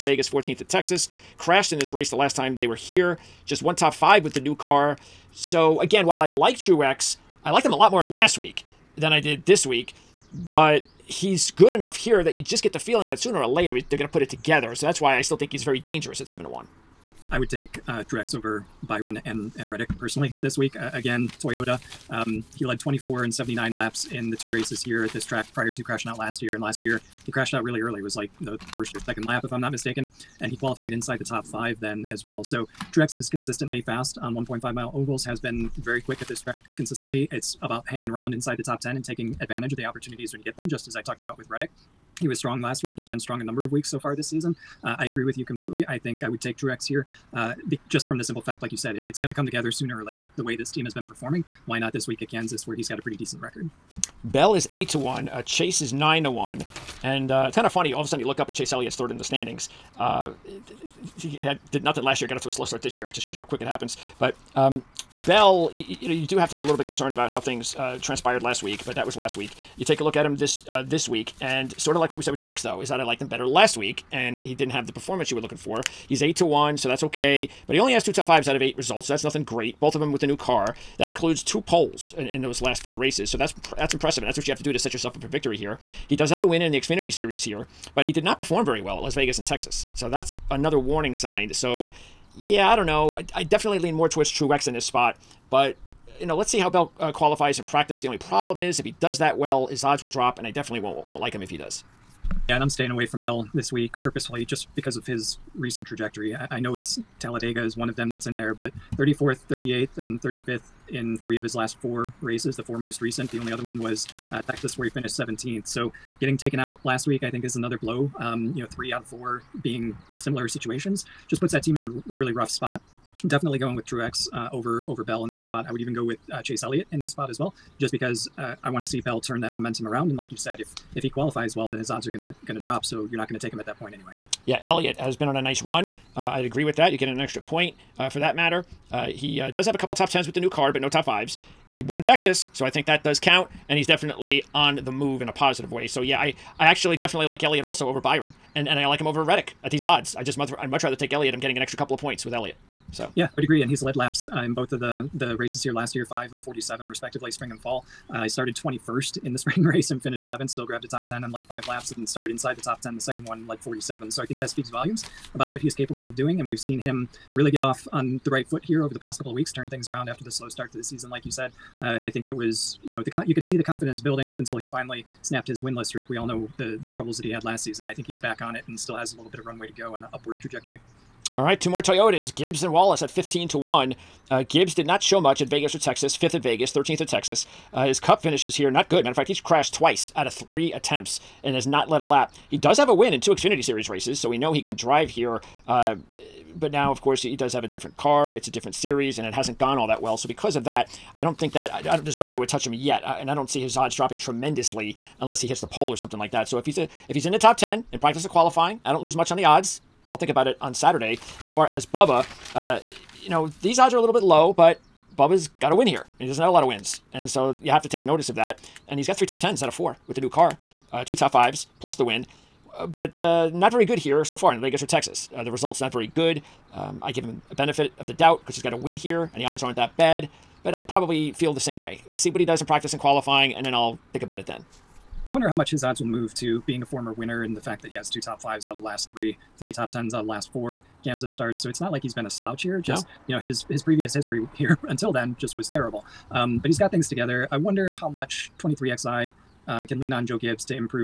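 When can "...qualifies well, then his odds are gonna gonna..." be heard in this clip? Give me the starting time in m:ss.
2:11.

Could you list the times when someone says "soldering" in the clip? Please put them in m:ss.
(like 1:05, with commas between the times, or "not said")
not said.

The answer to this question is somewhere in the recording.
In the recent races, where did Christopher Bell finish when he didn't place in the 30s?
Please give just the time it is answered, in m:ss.
1:55.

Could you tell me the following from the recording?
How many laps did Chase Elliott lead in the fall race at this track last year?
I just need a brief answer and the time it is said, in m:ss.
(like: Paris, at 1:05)
47, at 2:36.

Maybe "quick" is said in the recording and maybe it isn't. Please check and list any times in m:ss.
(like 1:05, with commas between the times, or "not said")
0:36, 1:03.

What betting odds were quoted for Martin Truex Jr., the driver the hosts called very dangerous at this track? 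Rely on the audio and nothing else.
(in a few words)
7 to 1.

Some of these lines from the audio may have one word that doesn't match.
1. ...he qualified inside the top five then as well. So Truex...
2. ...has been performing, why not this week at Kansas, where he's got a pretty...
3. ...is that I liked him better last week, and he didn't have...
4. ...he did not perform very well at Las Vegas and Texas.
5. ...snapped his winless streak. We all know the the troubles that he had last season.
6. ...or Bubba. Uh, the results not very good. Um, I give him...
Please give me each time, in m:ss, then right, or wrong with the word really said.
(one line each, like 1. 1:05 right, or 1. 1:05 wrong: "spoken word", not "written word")
1. 0:30 right
2. 0:50 right
3. 1:12 right
4. 1:28 right
5. 2:55 right
6. 3:44 wrong: "Texas", not "Bubba".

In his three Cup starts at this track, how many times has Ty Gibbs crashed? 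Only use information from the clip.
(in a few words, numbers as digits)
Twice.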